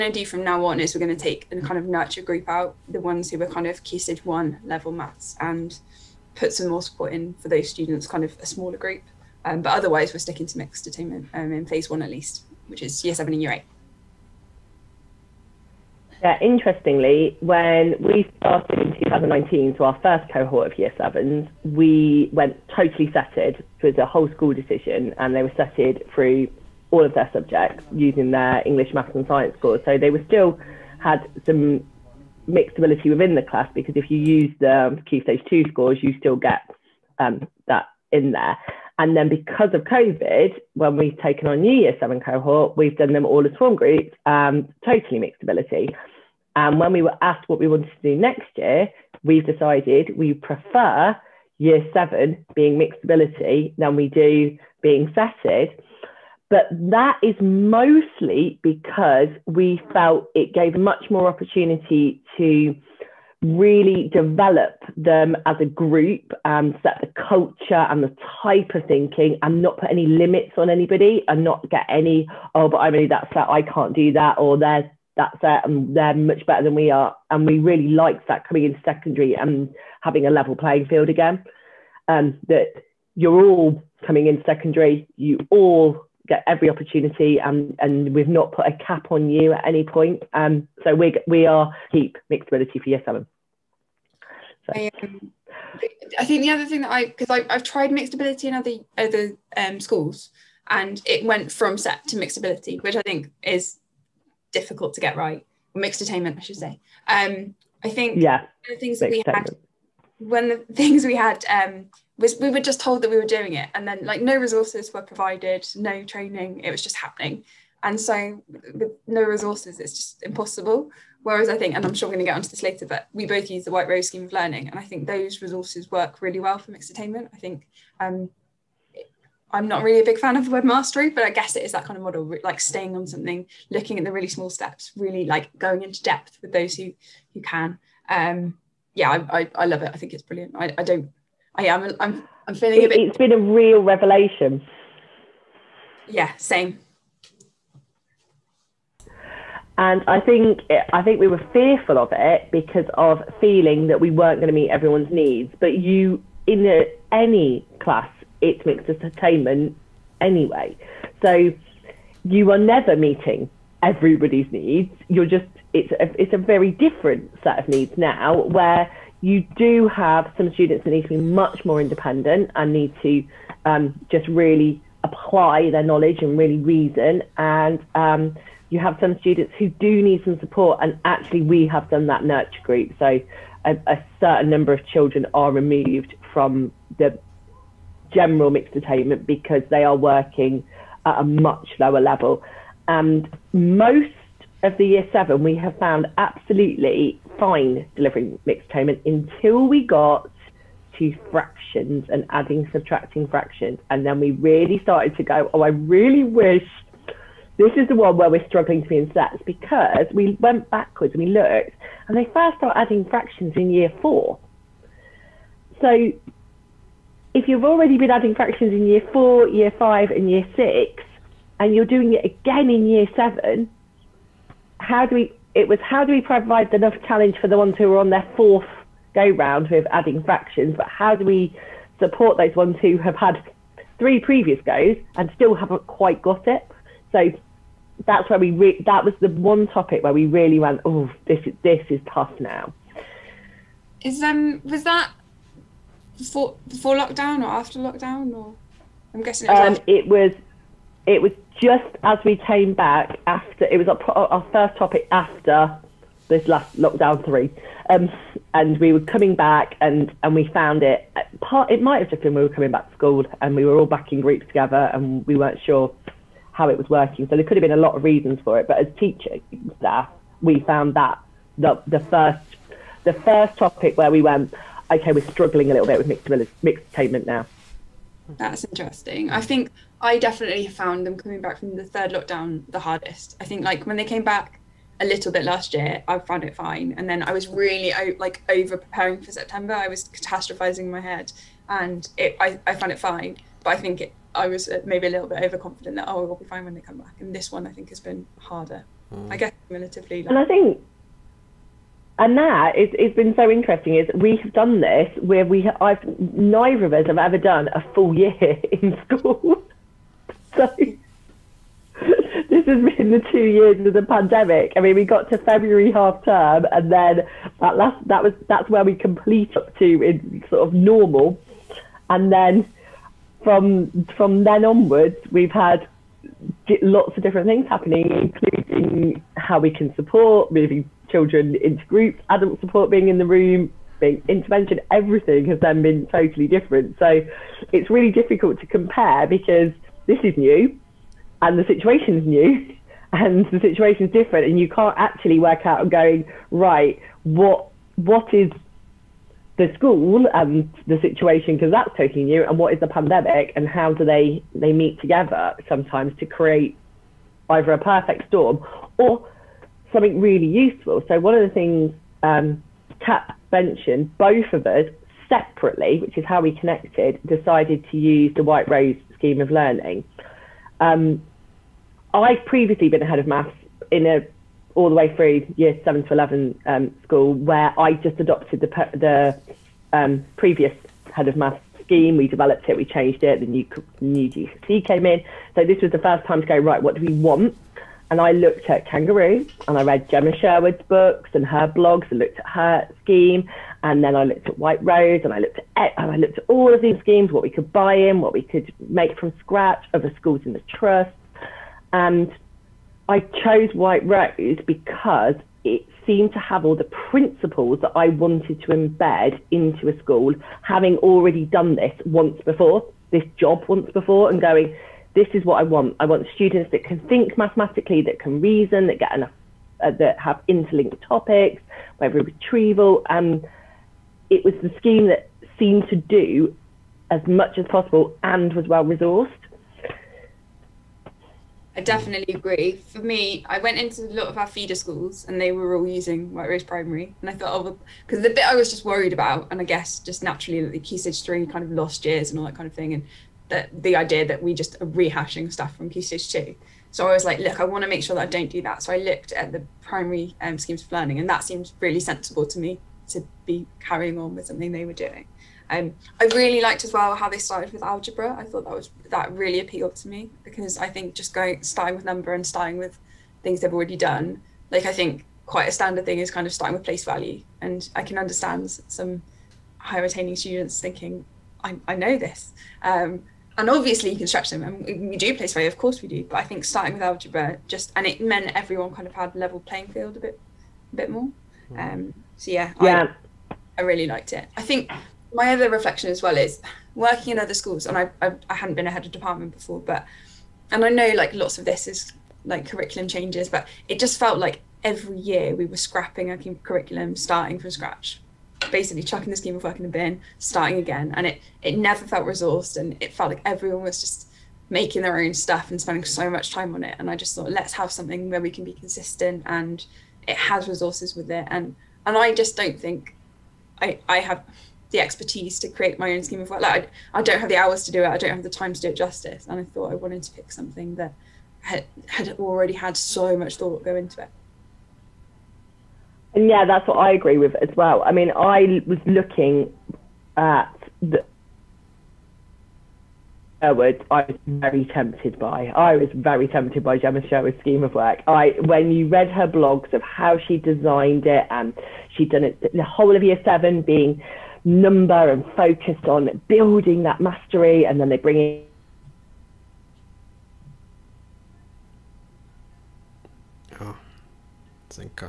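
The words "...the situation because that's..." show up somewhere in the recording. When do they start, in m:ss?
5:50.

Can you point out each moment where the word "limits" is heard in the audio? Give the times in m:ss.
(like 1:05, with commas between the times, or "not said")
1:10.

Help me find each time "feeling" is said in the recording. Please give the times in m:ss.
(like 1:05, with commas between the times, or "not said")
2:22, 2:33.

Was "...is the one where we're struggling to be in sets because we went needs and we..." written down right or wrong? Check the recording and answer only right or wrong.
wrong.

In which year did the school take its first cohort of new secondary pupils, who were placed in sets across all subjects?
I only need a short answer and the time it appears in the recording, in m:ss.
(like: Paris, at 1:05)
2019, at 0:18.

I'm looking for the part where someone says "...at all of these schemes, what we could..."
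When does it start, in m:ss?
6:36.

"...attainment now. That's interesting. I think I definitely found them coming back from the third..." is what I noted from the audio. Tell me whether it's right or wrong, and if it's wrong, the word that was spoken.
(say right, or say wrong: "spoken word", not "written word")
right.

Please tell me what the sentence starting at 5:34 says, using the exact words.
Everything has then been totally different.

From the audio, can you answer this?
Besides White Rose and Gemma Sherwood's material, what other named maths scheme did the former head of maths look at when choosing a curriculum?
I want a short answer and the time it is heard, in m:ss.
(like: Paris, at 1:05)
Kangaroo, at 6:28.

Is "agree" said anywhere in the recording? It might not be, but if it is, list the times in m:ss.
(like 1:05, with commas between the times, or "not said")
7:12, 8:47.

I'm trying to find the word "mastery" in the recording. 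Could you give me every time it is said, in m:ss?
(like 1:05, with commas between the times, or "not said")
2:10, 9:07.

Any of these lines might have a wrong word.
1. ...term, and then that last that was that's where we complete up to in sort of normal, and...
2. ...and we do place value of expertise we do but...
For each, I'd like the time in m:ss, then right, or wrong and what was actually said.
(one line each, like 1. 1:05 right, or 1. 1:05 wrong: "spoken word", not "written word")
1. 5:16 right
2. 7:54 wrong: "course", not "expertise".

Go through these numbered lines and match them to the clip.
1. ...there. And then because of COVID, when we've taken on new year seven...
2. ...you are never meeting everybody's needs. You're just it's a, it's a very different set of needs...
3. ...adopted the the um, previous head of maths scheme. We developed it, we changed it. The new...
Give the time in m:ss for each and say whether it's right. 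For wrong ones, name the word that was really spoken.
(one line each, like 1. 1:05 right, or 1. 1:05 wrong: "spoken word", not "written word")
1. 0:38 right
2. 2:42 right
3. 6:18 right.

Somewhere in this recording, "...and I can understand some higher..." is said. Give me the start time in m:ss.
7:47.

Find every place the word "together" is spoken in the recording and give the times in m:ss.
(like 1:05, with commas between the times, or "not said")
4:24, 5:55.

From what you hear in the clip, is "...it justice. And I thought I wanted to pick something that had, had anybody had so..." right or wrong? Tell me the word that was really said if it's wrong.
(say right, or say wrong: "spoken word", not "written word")
wrong: "already", not "anybody".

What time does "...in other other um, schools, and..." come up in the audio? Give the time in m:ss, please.
1:38.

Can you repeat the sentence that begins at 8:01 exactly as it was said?
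um, so yeah, yeah, I, I really liked it.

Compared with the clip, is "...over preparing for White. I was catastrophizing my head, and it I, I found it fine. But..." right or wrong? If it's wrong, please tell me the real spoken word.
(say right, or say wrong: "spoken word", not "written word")
wrong: "September", not "White".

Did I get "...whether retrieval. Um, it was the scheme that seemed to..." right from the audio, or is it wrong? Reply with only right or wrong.
right.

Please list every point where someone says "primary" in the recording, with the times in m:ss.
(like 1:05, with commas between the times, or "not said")
7:16, 7:29.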